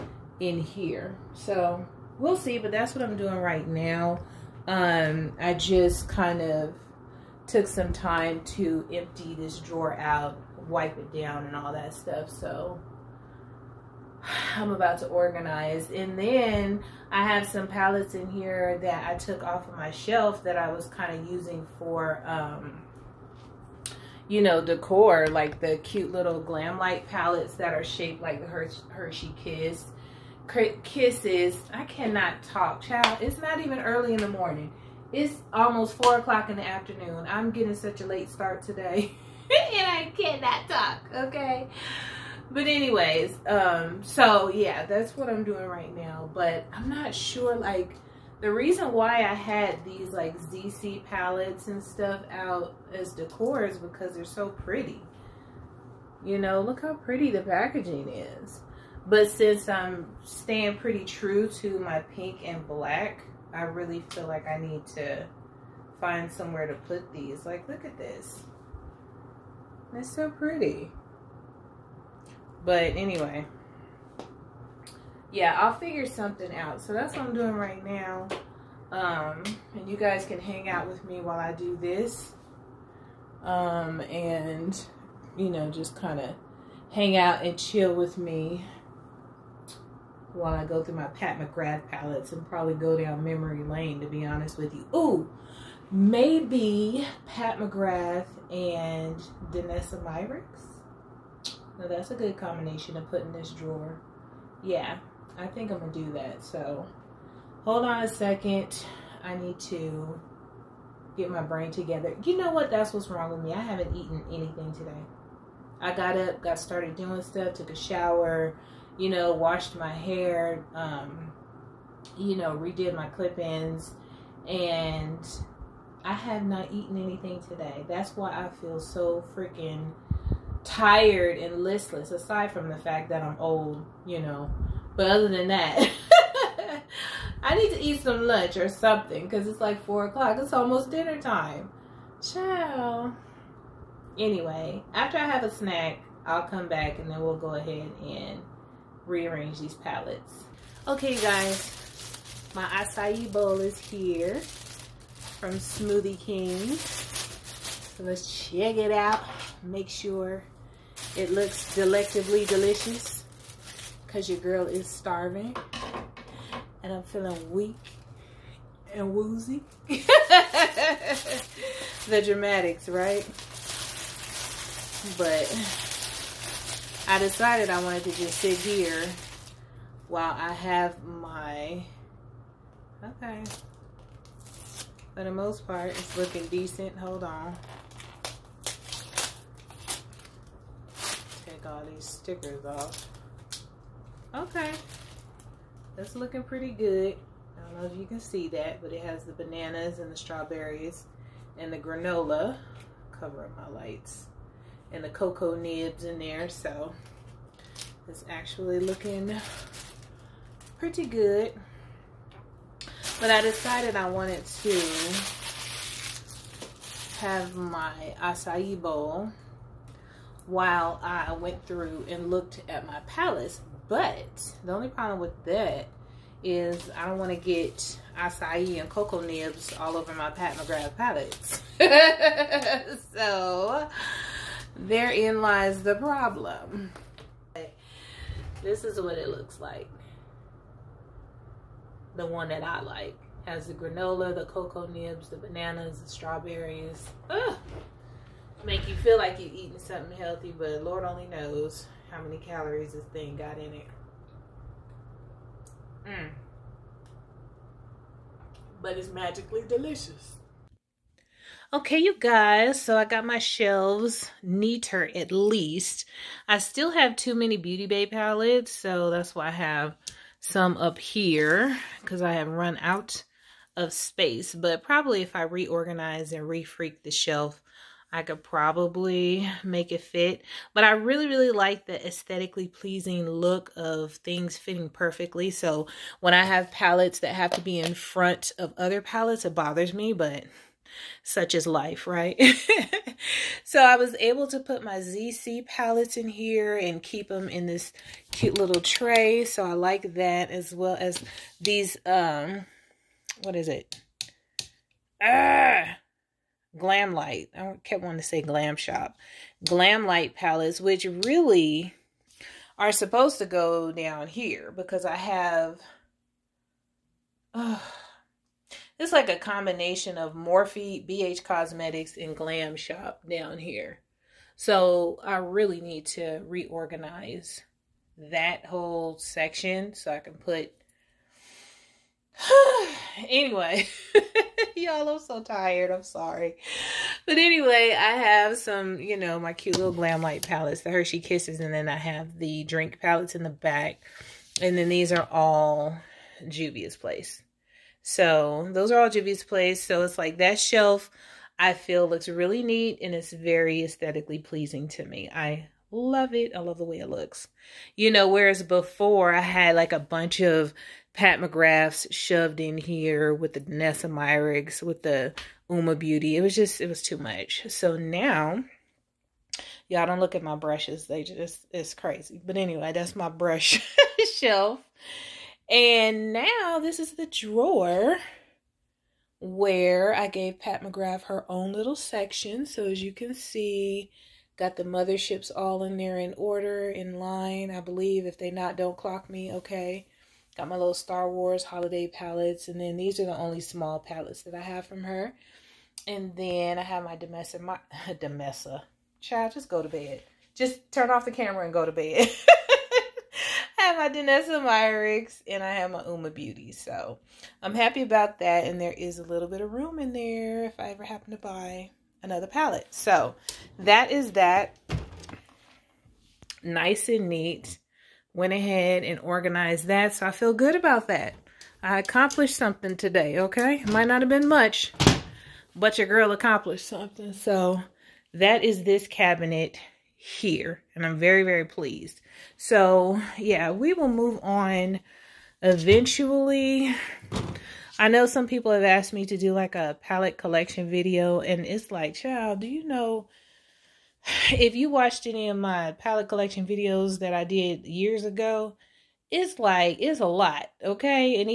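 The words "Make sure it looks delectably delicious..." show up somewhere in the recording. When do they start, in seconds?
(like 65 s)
159 s.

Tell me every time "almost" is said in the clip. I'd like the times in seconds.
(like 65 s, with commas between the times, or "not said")
35 s, 140 s.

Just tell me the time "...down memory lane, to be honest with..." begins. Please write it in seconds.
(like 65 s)
92 s.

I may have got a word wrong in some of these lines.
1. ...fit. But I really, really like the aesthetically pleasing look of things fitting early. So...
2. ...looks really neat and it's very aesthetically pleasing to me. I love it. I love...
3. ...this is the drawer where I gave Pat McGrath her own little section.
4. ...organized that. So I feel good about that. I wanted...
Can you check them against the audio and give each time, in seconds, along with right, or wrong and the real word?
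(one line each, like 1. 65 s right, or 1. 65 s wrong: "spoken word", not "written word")
1. 280 s wrong: "perfectly", not "early"
2. 352 s right
3. 376 s right
4. 419 s wrong: "accomplished", not "wanted".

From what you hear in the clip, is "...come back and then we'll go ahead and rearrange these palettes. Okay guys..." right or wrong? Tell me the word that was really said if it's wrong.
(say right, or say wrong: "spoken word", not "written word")
right.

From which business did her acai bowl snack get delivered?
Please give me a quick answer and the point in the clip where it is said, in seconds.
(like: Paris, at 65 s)
Smoothie King, at 155 s.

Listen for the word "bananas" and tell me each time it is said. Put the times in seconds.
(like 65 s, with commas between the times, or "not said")
199 s, 245 s.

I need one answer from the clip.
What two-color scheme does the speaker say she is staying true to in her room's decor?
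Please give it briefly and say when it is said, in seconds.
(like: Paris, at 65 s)
pink and black, at 61 s.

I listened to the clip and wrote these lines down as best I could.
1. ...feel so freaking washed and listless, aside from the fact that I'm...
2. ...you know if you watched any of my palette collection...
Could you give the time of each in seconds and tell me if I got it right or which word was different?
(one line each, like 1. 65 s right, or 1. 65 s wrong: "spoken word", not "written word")
1. 128 s wrong: "tired", not "washed"
2. 442 s right.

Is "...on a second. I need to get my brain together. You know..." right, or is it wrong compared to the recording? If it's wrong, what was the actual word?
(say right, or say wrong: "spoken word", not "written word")
right.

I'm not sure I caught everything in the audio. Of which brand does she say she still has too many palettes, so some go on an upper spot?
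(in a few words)
Beauty Bay.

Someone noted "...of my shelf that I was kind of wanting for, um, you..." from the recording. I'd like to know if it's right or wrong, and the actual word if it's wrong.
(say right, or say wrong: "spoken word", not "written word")
wrong: "using", not "wanting".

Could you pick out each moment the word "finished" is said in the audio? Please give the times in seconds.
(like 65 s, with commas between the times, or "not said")
not said.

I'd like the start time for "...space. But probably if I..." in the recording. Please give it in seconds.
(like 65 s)
273 s.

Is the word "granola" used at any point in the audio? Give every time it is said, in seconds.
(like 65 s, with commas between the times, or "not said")
201 s, 243 s.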